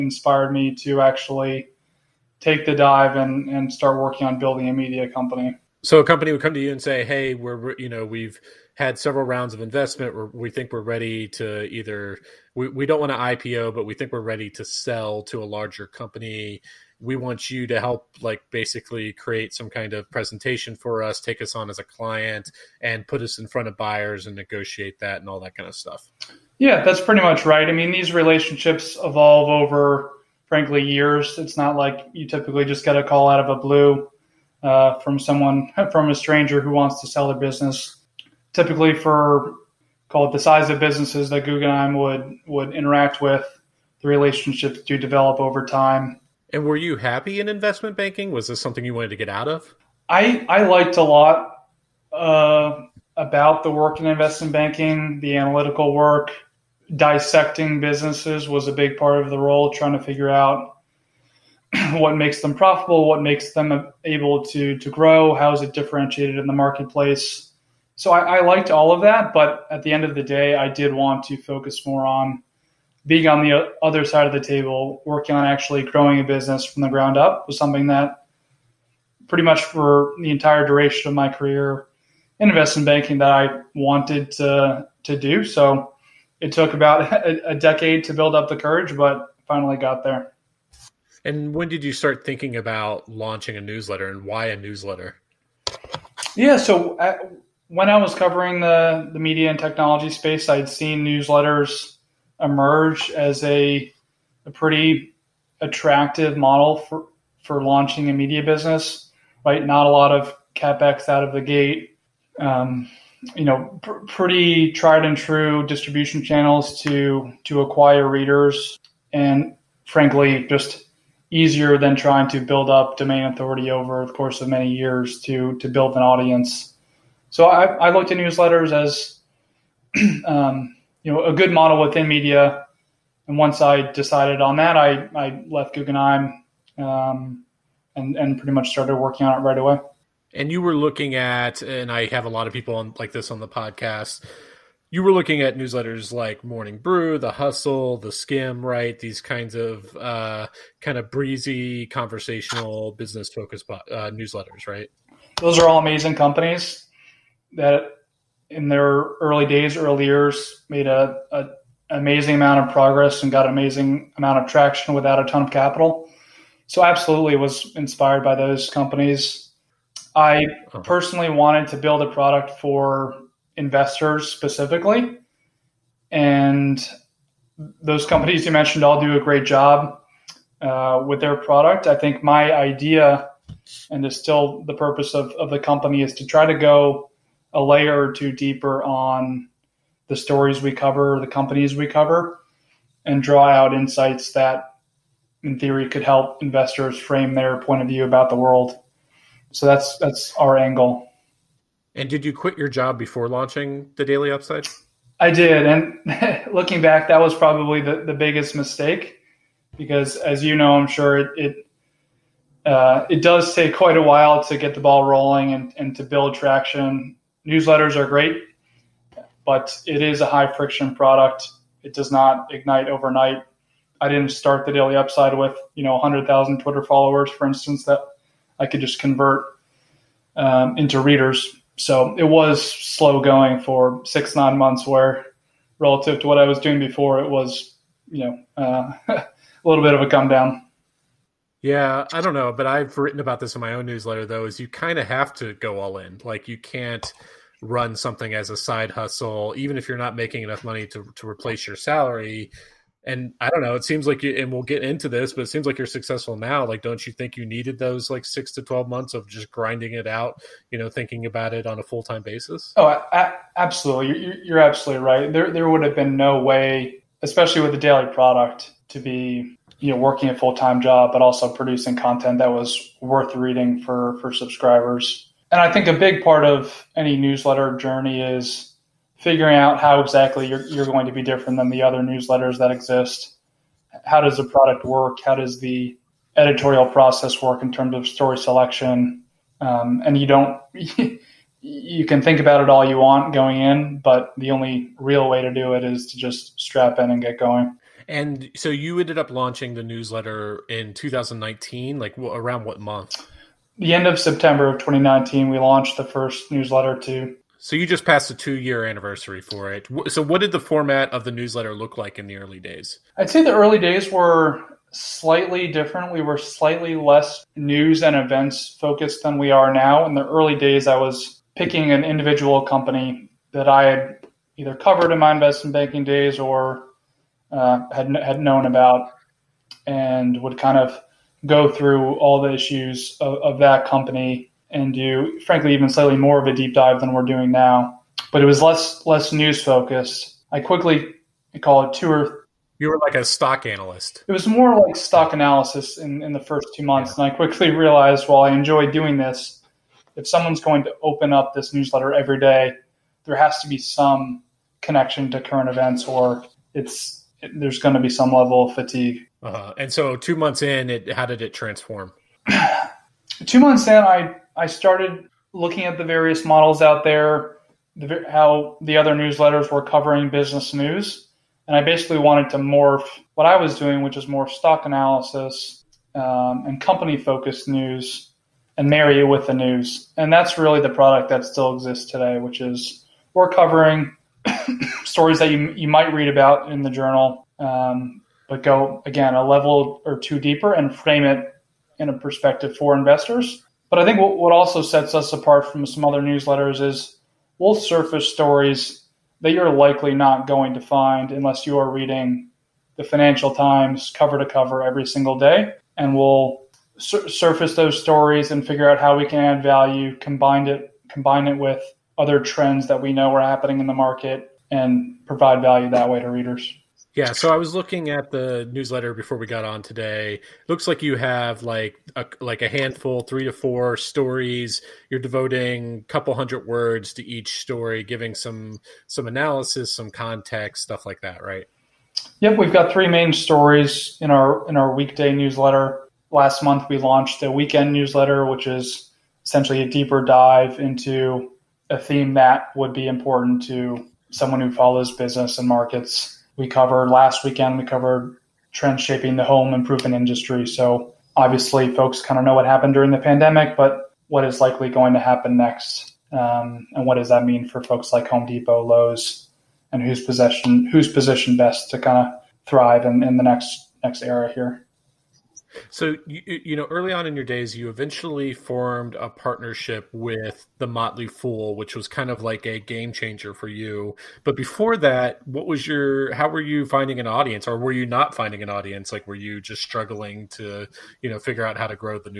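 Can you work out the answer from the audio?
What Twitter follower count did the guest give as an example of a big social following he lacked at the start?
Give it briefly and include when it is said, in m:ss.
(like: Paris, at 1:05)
100,000, at 3:45.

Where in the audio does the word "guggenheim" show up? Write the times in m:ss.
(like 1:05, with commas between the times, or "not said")
0:41, 2:15.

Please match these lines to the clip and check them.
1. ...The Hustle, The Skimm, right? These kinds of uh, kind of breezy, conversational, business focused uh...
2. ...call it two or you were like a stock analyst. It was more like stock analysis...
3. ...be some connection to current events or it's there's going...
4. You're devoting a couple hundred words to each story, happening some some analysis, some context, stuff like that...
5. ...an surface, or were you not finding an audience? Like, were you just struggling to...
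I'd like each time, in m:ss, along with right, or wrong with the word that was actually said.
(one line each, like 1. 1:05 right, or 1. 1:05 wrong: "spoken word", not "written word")
1. 2:27 right
2. 5:41 right
3. 5:53 right
4. 7:05 wrong: "giving", not "happening"
5. 7:57 wrong: "audience", not "surface".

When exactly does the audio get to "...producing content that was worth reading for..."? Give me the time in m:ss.
4:31.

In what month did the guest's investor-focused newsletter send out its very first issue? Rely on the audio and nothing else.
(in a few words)
September.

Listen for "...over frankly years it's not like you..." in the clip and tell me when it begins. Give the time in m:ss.
0:29.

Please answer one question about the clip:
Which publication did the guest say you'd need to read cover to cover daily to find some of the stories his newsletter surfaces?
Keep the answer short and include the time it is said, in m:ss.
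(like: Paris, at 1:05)
Financial Times, at 6:43.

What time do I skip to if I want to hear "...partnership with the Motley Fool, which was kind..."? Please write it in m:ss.
7:49.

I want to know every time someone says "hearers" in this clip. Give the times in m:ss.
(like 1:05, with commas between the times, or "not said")
not said.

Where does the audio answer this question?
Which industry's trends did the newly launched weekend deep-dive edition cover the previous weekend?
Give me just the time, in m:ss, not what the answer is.
7:29.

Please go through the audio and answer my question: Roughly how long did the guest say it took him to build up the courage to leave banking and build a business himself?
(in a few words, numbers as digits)
a decade.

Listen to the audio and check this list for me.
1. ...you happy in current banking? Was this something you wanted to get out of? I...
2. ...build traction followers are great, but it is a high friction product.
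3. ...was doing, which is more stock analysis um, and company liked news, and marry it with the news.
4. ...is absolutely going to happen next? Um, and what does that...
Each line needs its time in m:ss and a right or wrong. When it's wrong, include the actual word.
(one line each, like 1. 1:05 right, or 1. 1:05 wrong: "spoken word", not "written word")
1. 0:46 wrong: "investment", not "current"
2. 3:36 wrong: "newsletters", not "followers"
3. 6:13 wrong: "focused", not "liked"
4. 7:34 wrong: "likely", not "absolutely".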